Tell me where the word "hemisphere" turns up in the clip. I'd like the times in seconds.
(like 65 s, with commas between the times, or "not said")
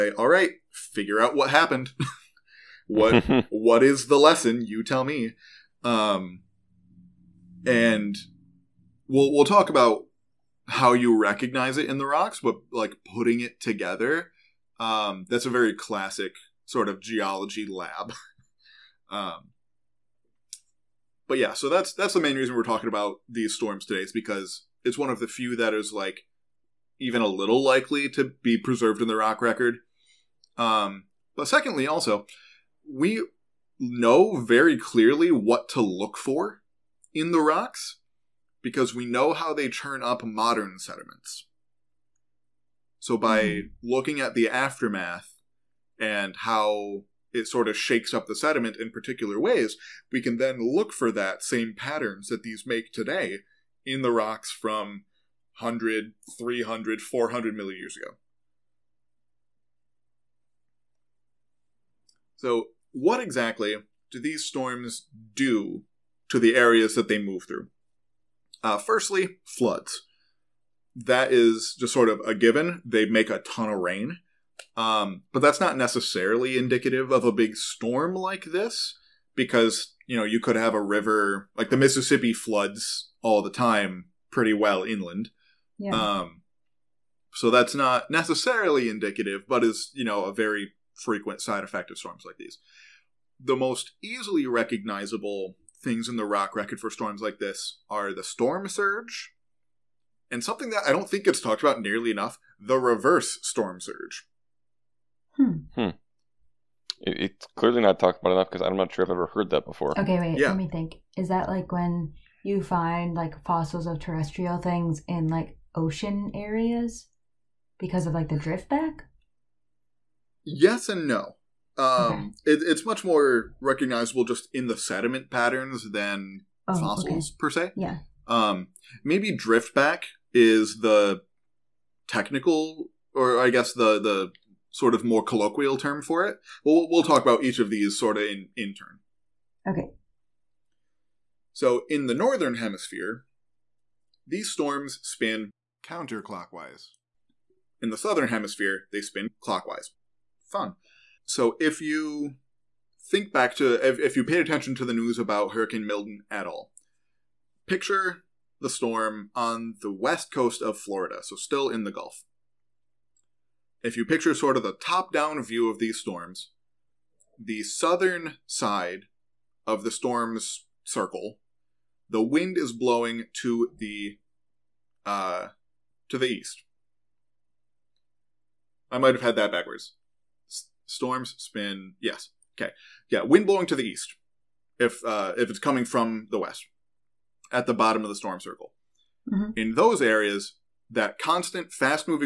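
142 s, 148 s.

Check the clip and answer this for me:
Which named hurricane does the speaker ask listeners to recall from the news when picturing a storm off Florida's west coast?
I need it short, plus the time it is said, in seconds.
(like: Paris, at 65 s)
Hurricane Milton, at 155 s.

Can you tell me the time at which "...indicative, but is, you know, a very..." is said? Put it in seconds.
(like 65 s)
88 s.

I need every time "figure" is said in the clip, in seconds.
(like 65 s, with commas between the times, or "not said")
0 s.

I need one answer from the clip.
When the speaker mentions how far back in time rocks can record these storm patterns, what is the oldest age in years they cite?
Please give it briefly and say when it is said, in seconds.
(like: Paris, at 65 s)
400 million years, at 57 s.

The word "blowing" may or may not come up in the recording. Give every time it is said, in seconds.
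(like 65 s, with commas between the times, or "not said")
172 s, 183 s.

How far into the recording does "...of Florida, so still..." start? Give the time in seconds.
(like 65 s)
160 s.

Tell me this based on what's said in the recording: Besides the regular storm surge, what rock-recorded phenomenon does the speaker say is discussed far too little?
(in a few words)
reverse storm surge.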